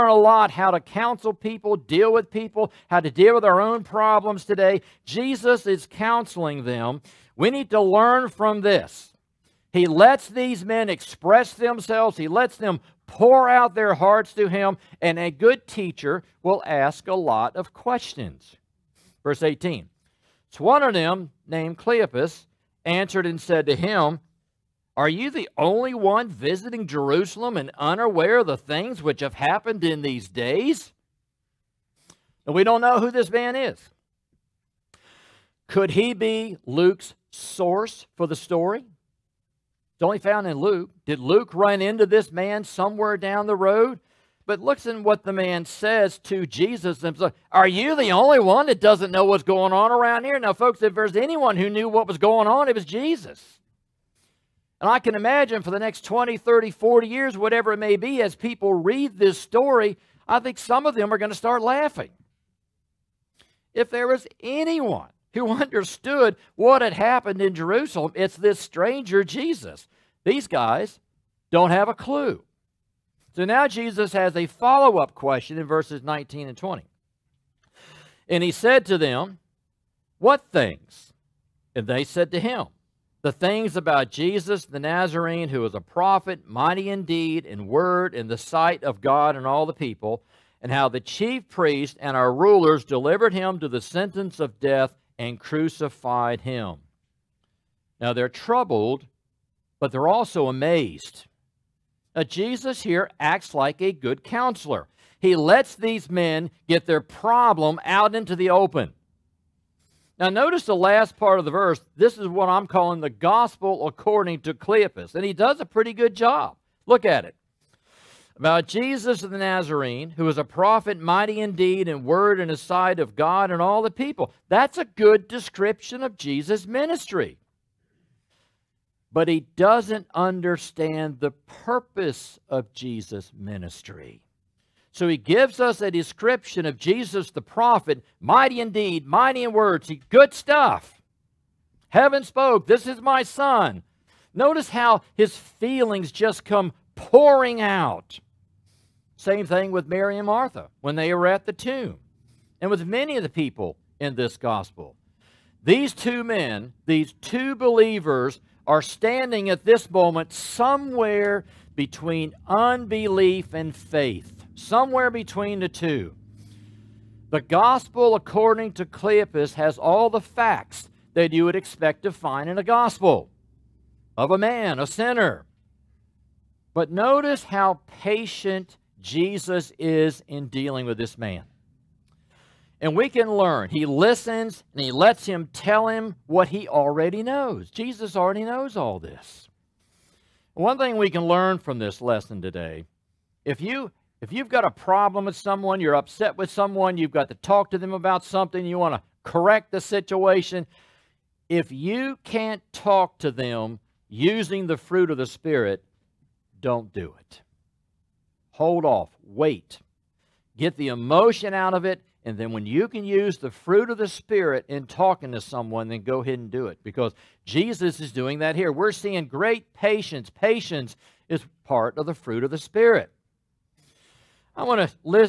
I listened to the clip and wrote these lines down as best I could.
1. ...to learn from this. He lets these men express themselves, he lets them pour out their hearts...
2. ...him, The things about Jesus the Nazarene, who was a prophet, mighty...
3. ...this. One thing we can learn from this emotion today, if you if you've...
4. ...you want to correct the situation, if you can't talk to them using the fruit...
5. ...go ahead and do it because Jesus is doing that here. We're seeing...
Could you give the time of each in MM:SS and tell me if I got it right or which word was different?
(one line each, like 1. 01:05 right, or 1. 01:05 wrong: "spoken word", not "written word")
1. 00:07 right
2. 01:22 right
3. 03:08 wrong: "lesson", not "emotion"
4. 03:18 right
5. 03:36 right.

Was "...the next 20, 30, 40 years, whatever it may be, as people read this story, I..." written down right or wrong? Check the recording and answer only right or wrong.
right.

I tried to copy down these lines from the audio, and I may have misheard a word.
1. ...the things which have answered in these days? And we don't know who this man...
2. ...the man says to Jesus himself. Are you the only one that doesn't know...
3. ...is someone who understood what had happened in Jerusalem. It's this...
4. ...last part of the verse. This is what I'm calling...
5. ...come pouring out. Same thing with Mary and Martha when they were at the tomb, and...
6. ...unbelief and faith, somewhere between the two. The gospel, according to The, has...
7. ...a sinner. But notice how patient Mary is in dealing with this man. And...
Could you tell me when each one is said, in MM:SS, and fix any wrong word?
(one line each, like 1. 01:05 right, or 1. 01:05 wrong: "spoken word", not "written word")
1. 00:28 wrong: "happened", not "answered"
2. 00:45 right
3. 01:04 wrong: "anyone", not "someone"
4. 01:50 right
5. 02:26 right
6. 02:42 wrong: "Cleopas", not "The"
7. 02:54 wrong: "Jesus", not "Mary".